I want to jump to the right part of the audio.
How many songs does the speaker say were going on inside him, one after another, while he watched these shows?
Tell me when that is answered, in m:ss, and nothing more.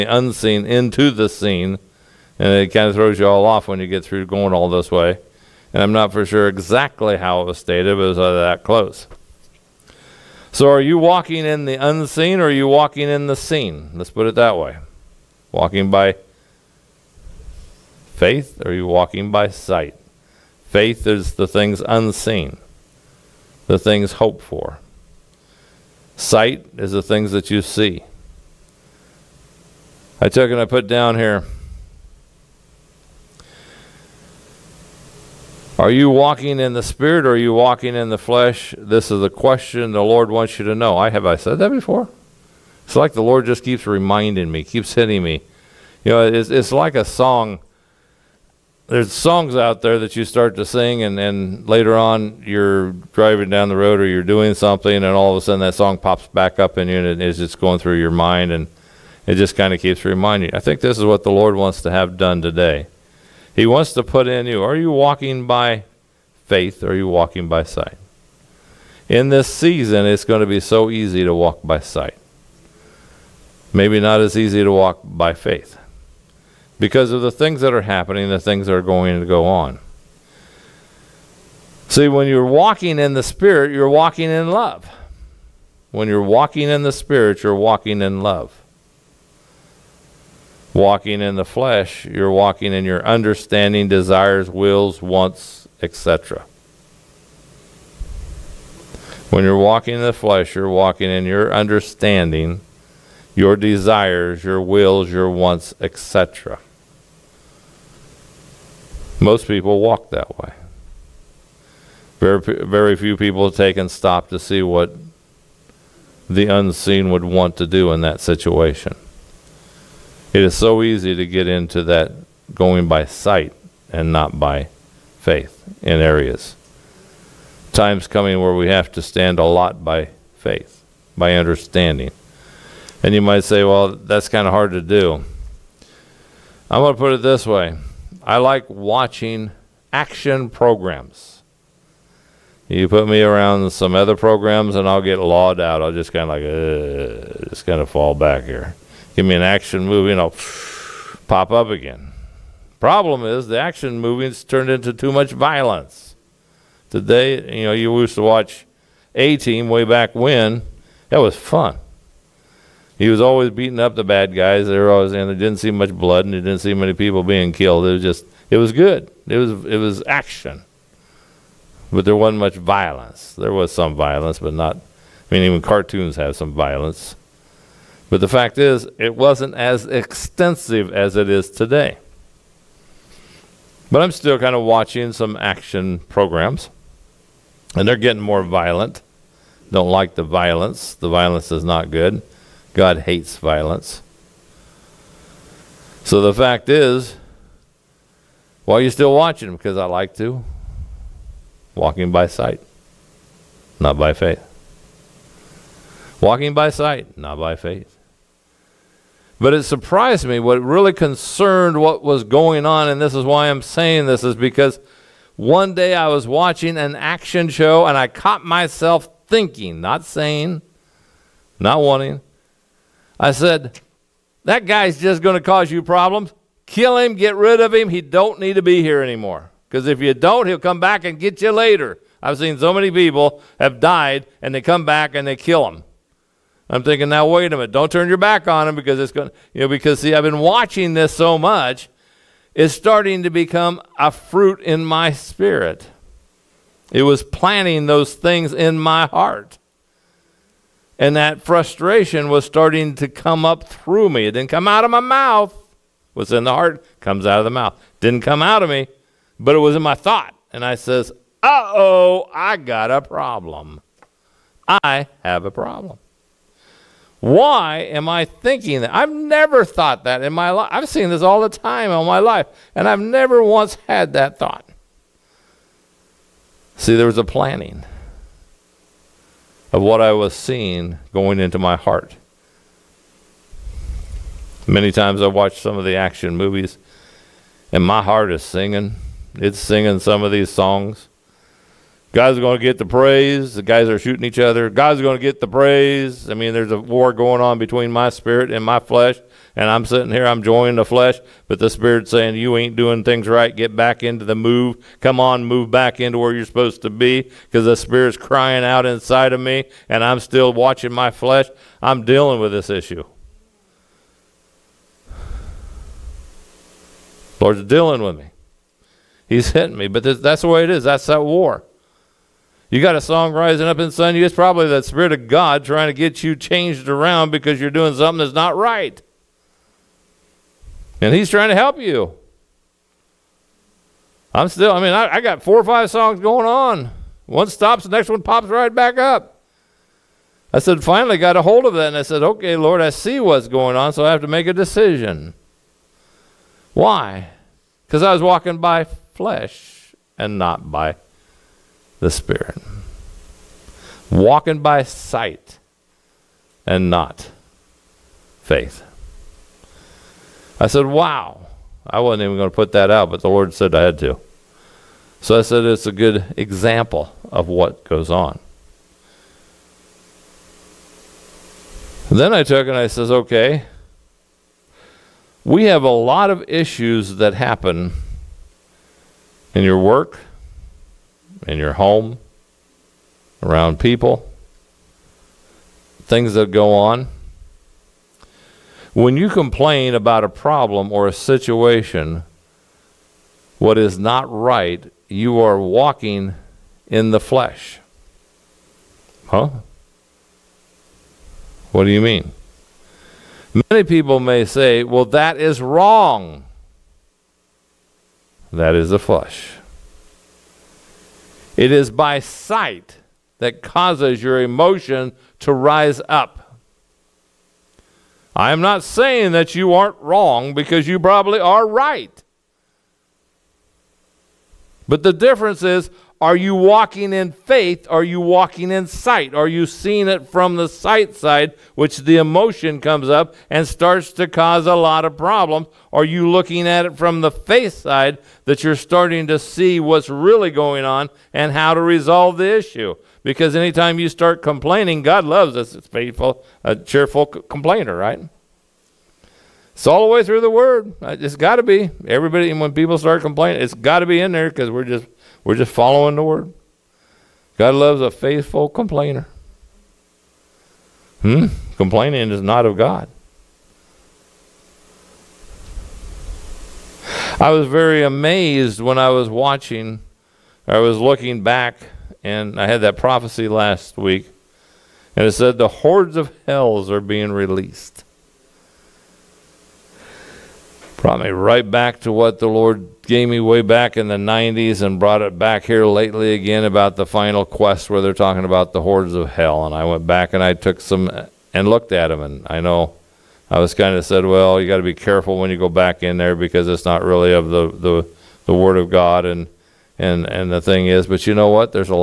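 5:35.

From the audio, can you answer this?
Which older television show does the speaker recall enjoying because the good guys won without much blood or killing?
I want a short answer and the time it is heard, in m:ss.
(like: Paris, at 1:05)
A Team, at 2:39.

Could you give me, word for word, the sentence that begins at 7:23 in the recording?
Because anytime you start complaining, God loves us.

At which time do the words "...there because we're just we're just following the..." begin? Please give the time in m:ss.
7:34.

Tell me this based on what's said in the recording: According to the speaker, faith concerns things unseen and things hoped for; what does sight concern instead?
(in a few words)
the things that you see.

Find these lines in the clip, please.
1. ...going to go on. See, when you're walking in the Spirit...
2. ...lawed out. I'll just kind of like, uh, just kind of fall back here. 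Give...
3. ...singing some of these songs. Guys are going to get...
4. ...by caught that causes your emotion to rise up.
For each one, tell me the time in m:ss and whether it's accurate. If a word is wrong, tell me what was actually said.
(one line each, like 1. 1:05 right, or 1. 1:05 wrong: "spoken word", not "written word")
1. 1:18 right
2. 2:25 right
3. 4:49 right
4. 6:51 wrong: "sight", not "caught".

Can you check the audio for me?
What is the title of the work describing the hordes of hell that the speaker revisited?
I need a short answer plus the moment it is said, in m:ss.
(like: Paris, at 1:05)
The Final Quest, at 8:07.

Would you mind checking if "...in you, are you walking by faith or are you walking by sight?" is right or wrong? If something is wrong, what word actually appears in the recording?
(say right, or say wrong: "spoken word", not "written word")
right.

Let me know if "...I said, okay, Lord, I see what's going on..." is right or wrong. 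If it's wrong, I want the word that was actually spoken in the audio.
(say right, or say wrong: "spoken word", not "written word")
right.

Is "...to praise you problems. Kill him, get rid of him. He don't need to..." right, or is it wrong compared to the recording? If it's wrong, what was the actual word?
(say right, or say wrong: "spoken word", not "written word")
wrong: "cause", not "praise".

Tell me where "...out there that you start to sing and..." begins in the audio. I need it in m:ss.
0:49.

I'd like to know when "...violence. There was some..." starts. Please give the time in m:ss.
2:52.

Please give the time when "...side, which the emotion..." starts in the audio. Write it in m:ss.
7:11.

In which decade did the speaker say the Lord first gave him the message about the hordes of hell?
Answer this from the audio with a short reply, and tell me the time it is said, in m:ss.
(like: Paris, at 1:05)
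the 90s, at 8:04.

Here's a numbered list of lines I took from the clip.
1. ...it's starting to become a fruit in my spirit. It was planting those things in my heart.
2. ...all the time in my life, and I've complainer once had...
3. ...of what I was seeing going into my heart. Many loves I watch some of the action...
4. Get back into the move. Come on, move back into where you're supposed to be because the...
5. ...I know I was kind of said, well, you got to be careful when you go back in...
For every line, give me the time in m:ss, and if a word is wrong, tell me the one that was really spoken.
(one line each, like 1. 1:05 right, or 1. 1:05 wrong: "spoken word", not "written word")
1. 4:02 right
2. 4:31 wrong: "never", not "complainer"
3. 4:39 wrong: "times", not "loves"
4. 5:03 right
5. 8:12 right.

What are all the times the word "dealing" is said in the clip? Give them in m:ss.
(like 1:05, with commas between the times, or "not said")
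5:12, 5:17.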